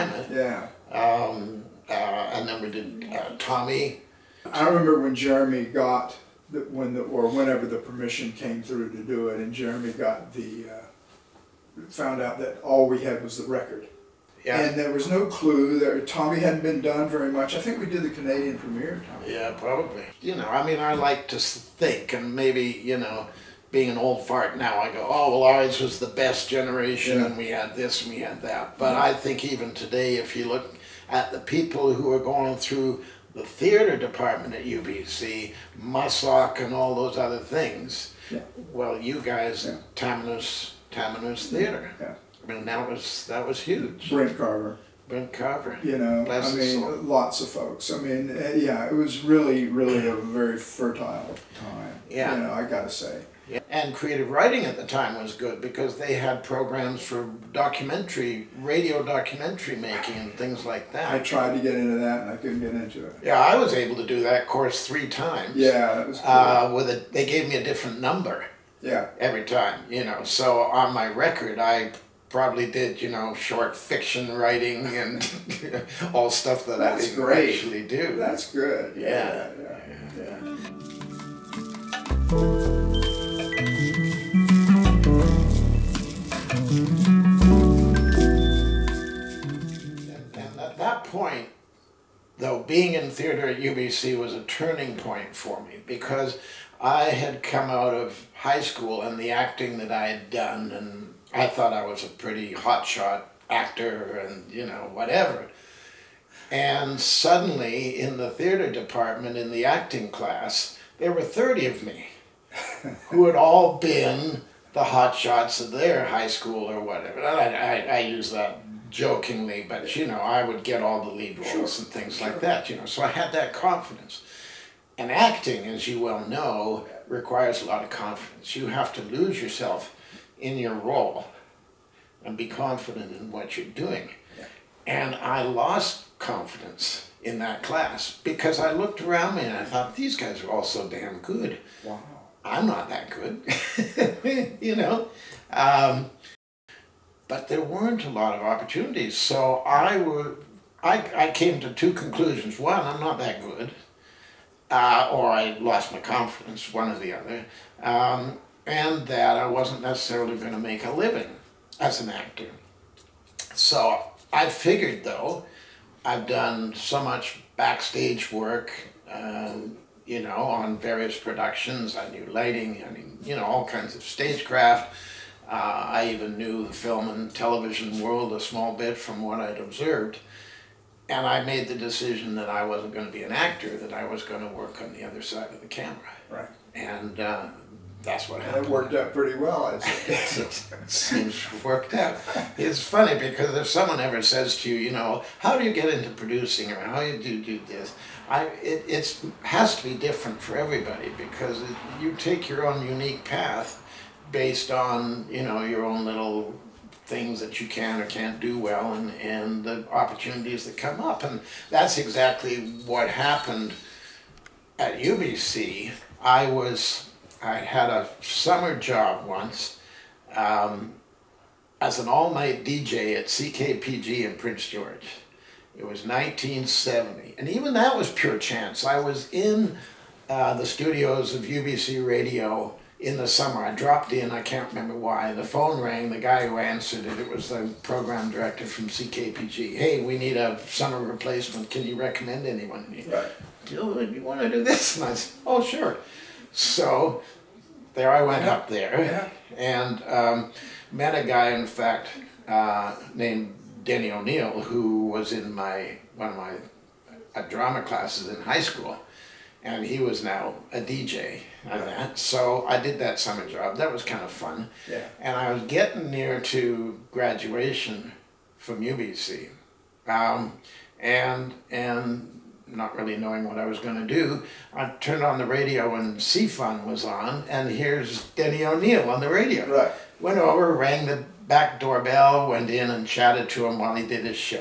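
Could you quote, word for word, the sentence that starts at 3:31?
And that's exactly what happened at UBC.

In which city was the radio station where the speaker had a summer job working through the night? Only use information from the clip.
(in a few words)
Prince George.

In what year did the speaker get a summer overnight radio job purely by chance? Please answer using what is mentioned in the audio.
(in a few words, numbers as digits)
1970.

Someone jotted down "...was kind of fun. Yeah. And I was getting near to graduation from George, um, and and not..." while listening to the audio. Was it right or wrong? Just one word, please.
wrong.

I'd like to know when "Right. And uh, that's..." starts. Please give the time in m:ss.
3:06.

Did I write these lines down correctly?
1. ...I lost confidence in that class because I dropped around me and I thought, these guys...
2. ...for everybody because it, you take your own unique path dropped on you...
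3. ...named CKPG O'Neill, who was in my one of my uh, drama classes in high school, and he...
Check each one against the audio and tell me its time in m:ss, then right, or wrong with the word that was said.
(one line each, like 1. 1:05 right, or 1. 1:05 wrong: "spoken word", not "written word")
1. 2:15 wrong: "looked", not "dropped"
2. 3:20 wrong: "based", not "dropped"
3. 4:13 wrong: "Denny", not "CKPG".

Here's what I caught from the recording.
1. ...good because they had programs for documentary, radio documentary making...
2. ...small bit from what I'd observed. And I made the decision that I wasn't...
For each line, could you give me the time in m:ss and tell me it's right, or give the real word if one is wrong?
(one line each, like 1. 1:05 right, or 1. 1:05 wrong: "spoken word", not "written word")
1. 0:55 right
2. 2:58 right.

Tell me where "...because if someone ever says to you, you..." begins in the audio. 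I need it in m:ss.
3:13.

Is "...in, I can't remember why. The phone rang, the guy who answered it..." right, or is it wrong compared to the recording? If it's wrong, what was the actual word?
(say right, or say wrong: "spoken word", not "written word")
right.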